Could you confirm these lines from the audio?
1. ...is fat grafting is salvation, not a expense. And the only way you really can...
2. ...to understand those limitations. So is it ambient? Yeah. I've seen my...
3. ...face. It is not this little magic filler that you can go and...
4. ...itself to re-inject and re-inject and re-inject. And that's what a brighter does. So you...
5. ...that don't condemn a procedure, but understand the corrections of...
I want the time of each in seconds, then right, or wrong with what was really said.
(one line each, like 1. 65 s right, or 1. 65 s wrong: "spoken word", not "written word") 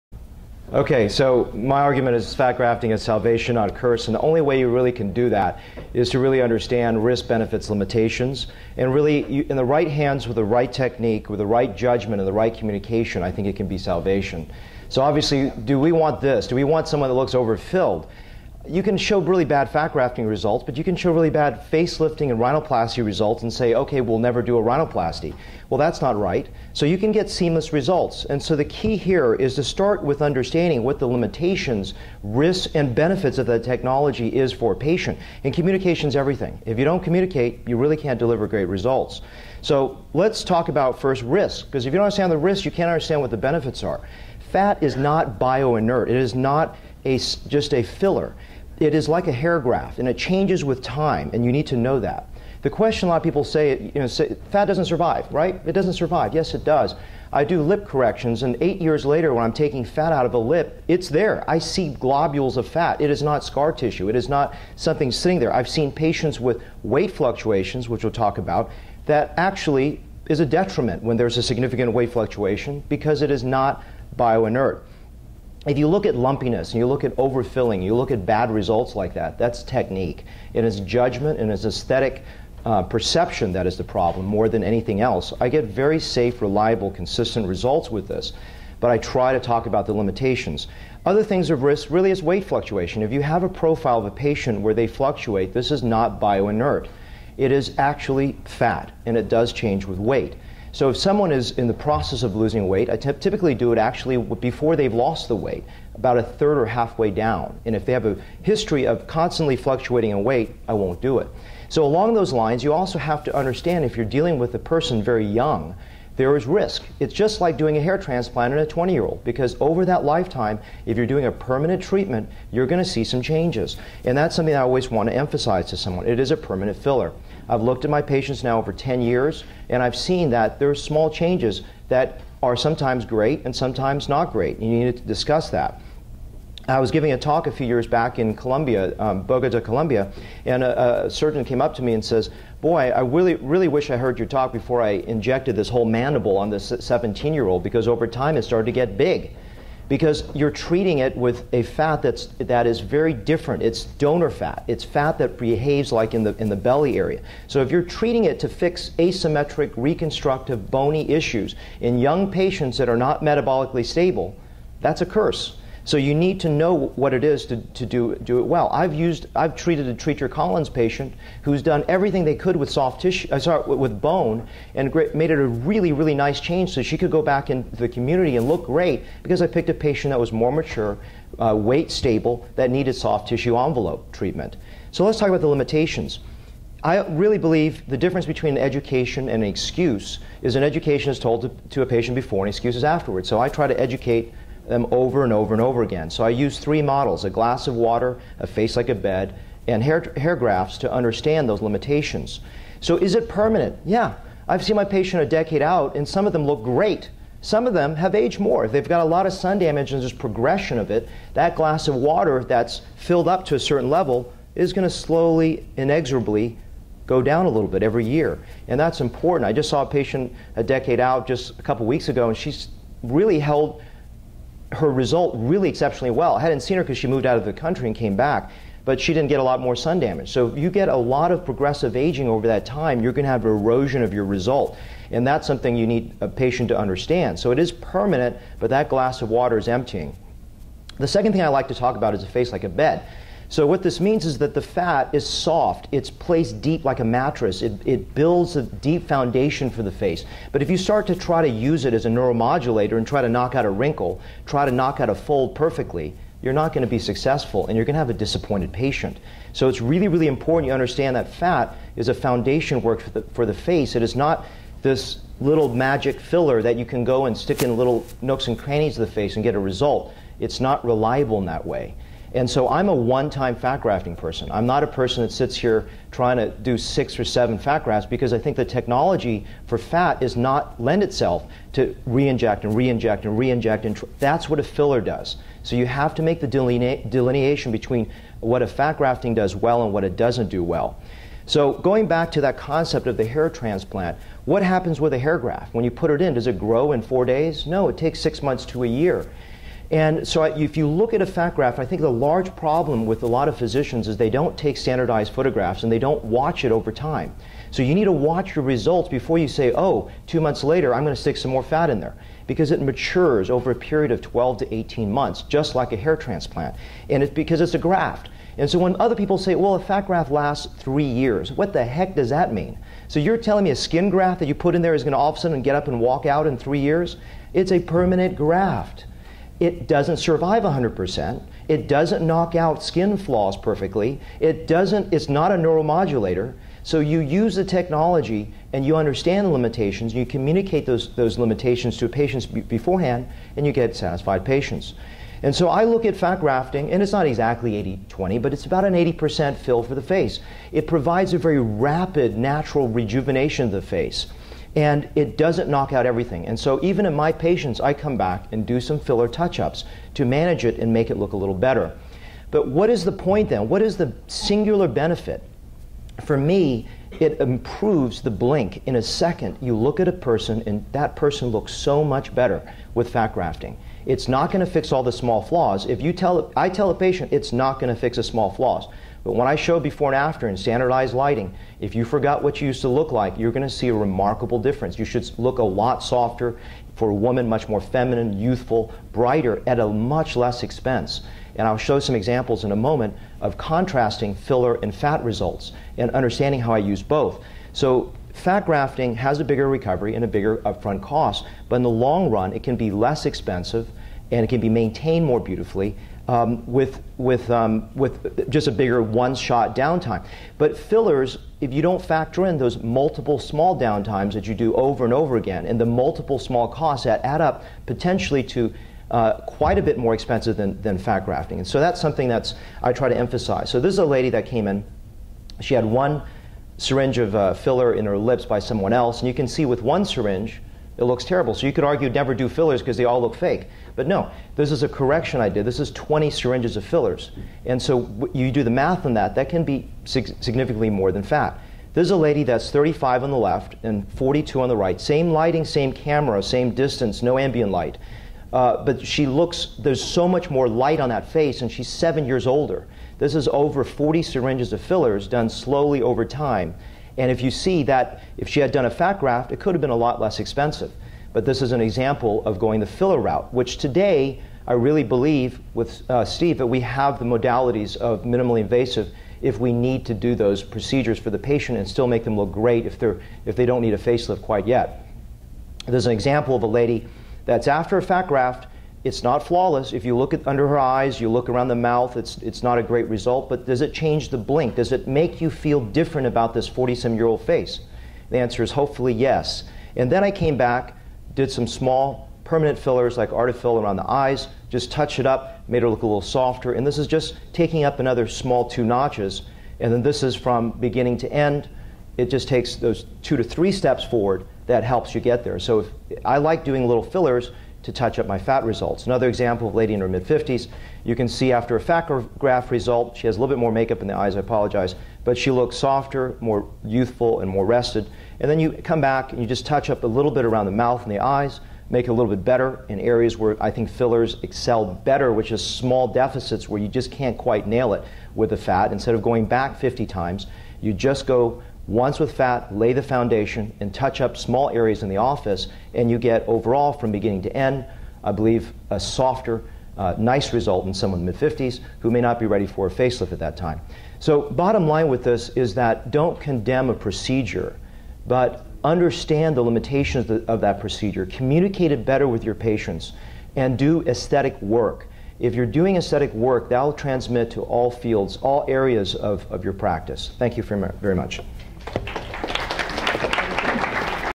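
1. 2 s wrong: "curse", not "expense"
2. 200 s wrong: "permanent", not "ambient"
3. 263 s right
4. 281 s wrong: "filler", not "brighter"
5. 545 s wrong: "limitations", not "corrections".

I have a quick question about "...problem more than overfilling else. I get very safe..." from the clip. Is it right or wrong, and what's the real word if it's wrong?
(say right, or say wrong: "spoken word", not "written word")
wrong: "anything", not "overfilling".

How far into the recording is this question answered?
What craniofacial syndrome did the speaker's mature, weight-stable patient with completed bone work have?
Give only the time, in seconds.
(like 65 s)
169 s.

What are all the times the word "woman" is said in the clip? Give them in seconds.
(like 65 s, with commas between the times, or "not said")
387 s.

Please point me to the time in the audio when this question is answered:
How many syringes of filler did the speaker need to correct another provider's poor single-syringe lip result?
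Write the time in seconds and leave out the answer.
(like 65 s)
435 s.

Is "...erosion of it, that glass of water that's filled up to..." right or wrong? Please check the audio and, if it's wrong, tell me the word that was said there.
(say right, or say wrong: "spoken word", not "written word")
wrong: "progression", not "erosion".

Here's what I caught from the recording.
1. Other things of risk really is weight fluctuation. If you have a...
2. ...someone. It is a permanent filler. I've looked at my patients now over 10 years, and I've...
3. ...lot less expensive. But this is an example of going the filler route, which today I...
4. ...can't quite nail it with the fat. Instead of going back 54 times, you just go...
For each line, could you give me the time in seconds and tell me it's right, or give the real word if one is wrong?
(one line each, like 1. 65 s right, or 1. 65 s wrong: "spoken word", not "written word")
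1. 91 s right
2. 125 s right
3. 459 s right
4. 527 s wrong: "50", not "54".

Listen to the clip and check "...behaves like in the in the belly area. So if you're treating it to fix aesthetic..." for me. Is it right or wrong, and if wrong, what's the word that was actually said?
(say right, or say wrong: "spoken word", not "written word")
wrong: "asymmetric", not "aesthetic".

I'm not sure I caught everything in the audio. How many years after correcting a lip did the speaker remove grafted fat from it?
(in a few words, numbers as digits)
8.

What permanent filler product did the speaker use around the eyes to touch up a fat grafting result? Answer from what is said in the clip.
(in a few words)
Artefill.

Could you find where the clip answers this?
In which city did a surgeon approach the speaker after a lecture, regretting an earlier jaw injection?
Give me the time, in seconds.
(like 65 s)
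139 s.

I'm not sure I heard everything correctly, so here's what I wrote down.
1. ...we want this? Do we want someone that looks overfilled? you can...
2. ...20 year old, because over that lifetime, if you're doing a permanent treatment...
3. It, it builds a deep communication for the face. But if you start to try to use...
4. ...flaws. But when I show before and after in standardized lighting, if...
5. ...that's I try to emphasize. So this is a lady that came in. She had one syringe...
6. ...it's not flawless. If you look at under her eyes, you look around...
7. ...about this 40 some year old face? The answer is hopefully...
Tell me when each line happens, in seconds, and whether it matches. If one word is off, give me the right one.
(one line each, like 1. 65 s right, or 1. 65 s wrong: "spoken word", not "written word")
1. 15 s right
2. 118 s right
3. 247 s wrong: "foundation", not "communication"
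4. 378 s right
5. 422 s right
6. 479 s right
7. 486 s right.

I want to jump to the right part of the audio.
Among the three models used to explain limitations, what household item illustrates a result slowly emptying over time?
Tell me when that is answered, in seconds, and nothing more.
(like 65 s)
197 s.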